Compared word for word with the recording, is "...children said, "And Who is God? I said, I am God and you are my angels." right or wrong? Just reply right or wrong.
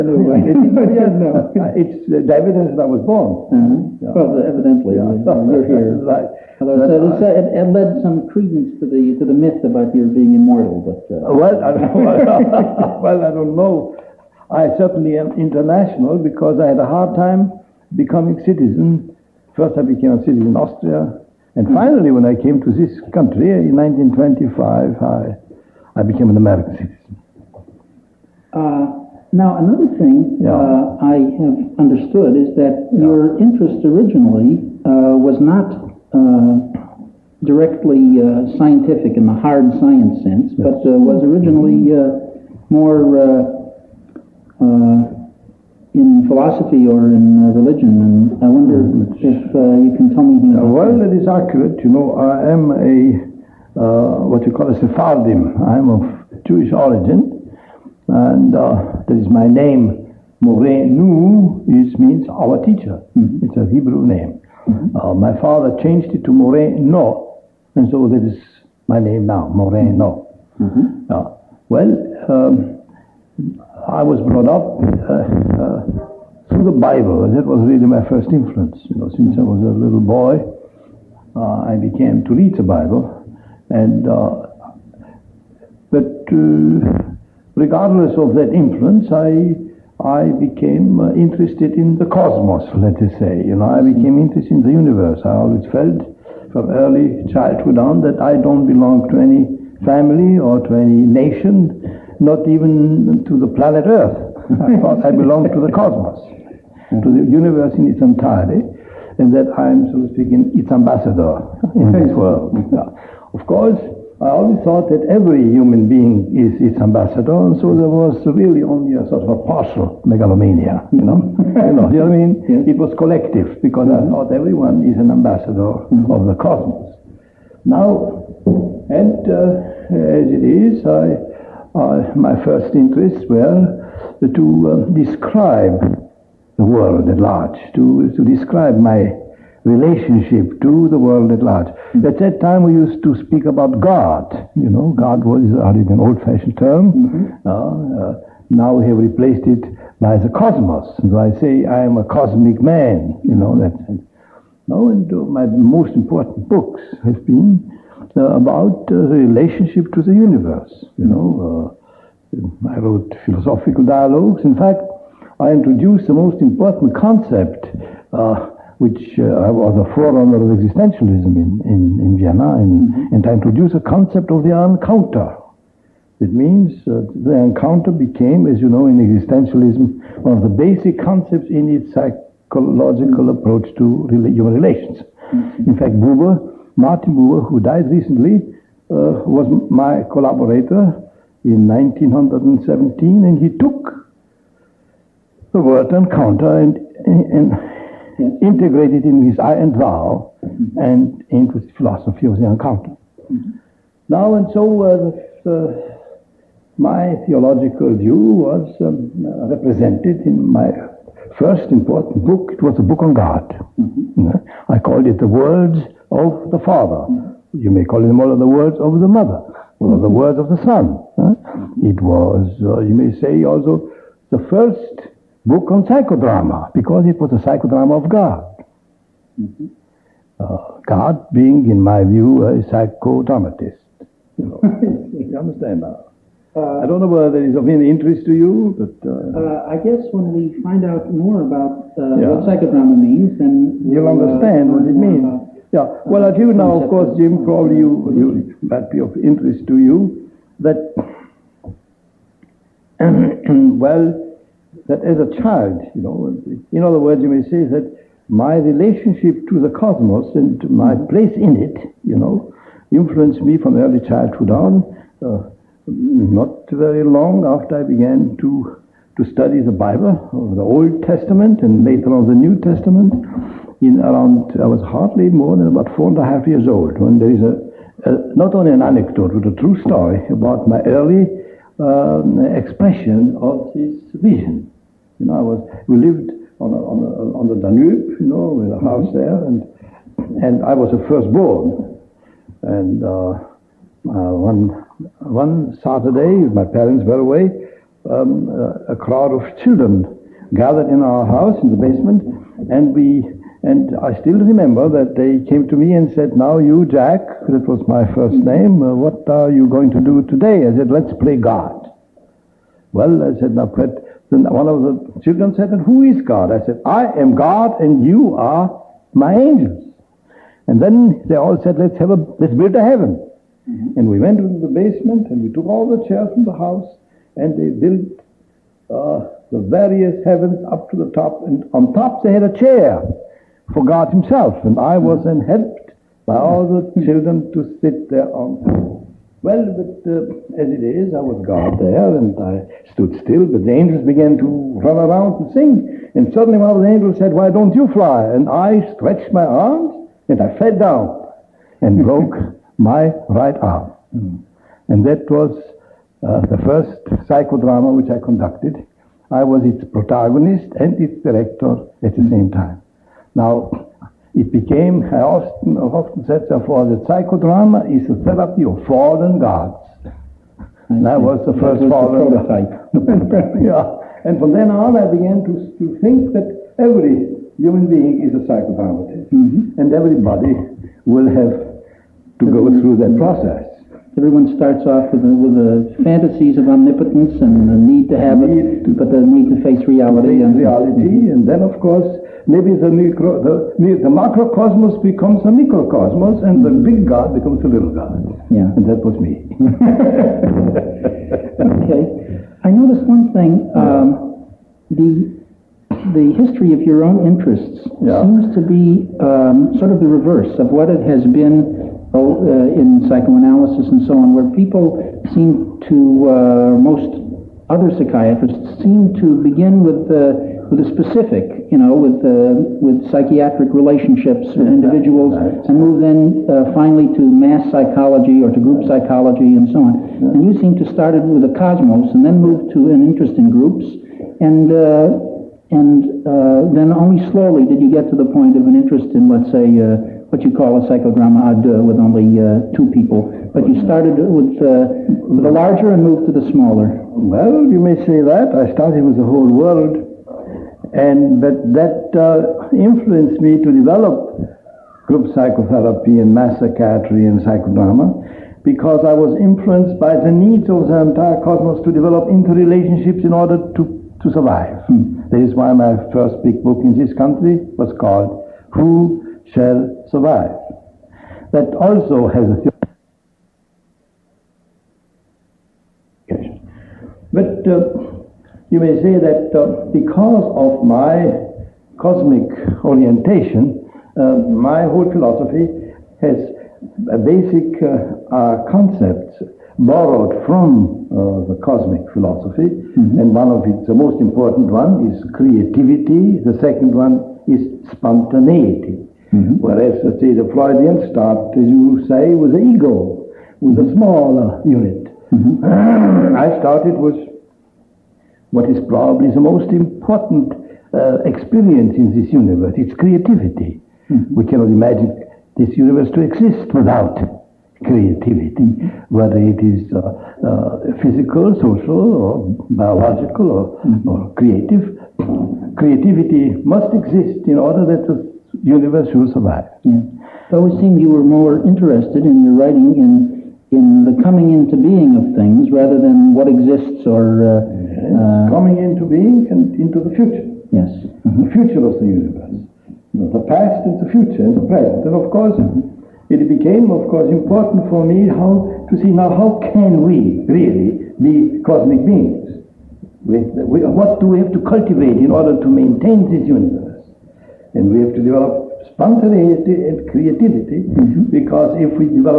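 right.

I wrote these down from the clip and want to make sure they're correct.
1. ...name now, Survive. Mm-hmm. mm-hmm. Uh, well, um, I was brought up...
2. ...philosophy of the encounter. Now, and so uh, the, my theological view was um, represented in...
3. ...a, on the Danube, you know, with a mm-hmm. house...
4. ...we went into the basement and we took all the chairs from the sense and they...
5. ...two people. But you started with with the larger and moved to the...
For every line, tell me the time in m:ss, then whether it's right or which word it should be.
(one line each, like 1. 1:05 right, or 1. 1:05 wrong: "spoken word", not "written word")
1. 1:08 wrong: "Moreno", not "Survive"
2. 3:21 right
3. 4:47 right
4. 5:24 wrong: "house", not "sense"
5. 7:22 right.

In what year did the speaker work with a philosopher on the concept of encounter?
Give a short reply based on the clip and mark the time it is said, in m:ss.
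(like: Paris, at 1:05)
1917, at 3:11.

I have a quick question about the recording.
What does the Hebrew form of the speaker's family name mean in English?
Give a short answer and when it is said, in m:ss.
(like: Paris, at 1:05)
our teacher, at 1:02.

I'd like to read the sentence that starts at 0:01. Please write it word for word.
Uh, it's the evidence that I was born.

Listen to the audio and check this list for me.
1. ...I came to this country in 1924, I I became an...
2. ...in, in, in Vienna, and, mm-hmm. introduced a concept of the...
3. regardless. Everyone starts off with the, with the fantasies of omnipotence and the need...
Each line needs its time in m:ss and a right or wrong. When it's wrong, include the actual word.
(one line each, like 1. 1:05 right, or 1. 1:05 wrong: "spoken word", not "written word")
1. 0:22 wrong: "1925", not "1924"
2. 2:51 right
3. 6:23 wrong: "process", not "regardless".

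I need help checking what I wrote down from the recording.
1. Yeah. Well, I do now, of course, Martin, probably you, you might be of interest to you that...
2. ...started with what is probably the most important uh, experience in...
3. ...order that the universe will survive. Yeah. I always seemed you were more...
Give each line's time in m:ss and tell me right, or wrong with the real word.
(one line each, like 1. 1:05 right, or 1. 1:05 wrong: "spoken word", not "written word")
1. 4:05 wrong: "Jim", not "Martin"
2. 8:26 right
3. 8:47 right.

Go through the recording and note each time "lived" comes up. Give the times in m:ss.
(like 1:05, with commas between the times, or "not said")
4:45.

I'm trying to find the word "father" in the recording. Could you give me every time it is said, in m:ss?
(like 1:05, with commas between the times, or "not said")
1:05, 3:36.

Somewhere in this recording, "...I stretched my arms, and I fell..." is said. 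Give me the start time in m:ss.
5:48.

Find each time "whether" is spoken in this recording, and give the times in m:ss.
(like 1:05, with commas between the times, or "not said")
3:57, 8:39.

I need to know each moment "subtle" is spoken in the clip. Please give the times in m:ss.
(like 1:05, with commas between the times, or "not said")
not said.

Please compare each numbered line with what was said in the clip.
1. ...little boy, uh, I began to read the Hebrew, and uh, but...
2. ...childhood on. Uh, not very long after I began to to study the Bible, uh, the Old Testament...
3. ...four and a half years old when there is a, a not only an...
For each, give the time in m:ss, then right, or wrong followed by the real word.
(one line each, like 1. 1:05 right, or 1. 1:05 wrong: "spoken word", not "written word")
1. 1:19 wrong: "Bible", not "Hebrew"
2. 4:24 right
3. 4:35 right.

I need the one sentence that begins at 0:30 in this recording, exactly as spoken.
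Uh, I have understood is that yeah.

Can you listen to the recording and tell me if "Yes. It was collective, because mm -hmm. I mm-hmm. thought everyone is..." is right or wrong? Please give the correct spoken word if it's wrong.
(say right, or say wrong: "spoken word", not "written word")
right.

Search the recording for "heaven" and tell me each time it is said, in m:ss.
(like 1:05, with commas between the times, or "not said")
5:22, 5:30.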